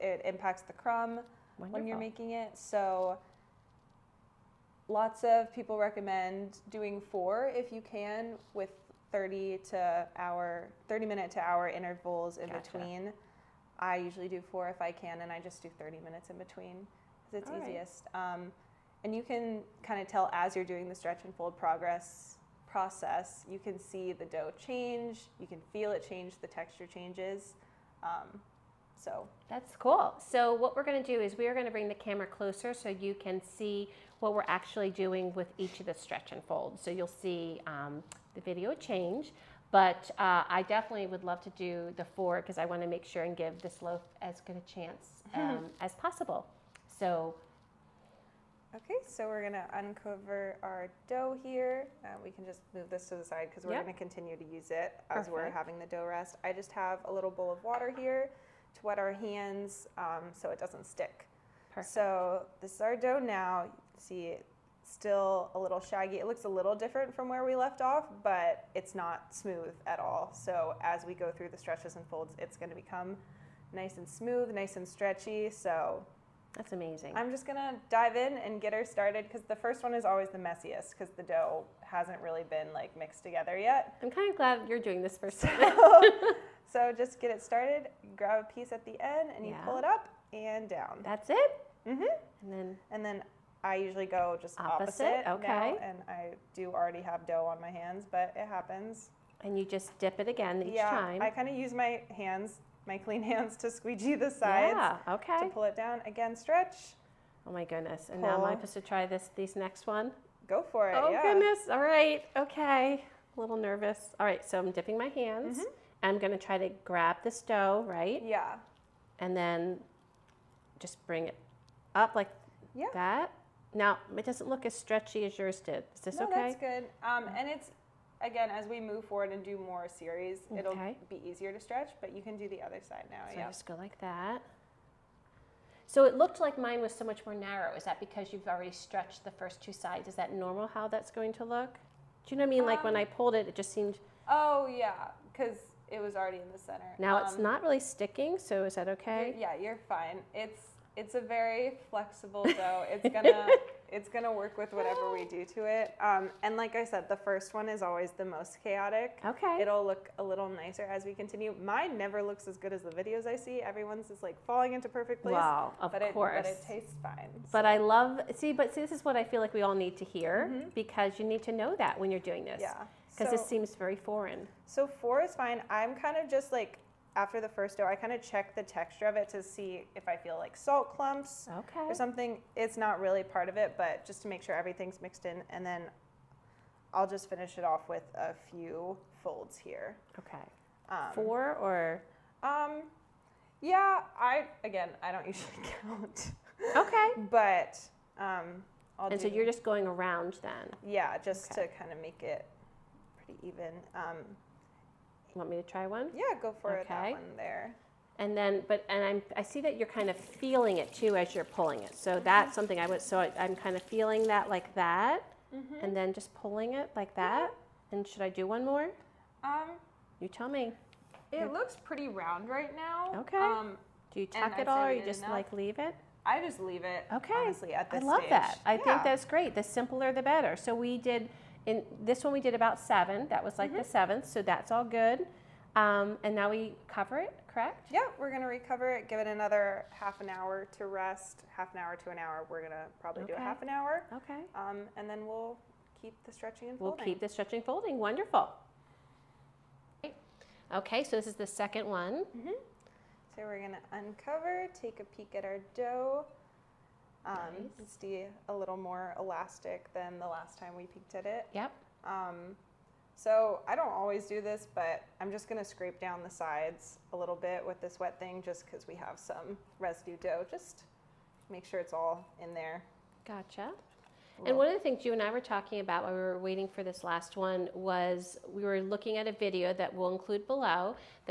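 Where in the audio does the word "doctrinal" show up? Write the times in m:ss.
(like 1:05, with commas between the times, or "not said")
not said.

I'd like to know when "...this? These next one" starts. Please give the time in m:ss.
1:49.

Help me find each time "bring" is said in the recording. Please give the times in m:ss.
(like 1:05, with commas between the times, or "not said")
0:31, 2:01.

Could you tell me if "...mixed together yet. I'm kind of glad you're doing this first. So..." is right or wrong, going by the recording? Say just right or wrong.
right.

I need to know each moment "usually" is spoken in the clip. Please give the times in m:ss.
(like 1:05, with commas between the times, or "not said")
0:13, 1:33, 3:15.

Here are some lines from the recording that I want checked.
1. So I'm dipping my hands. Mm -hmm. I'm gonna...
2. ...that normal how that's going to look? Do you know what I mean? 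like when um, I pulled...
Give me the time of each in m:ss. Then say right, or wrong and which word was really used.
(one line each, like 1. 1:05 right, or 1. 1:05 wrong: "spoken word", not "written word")
1. 1:54 right
2. 2:20 right.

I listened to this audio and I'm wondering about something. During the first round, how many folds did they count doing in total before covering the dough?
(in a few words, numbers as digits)
7.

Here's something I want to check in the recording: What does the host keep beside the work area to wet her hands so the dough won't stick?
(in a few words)
A little bowl of water.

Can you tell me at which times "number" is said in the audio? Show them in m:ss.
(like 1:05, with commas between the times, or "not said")
not said.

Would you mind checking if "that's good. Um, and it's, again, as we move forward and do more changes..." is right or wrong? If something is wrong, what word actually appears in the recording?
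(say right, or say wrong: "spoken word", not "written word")
wrong: "series", not "changes".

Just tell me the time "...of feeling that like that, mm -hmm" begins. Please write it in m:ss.
3:33.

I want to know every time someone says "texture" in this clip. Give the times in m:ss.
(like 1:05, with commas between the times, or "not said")
0:26, 2:58.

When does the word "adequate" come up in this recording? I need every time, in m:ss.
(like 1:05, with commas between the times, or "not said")
not said.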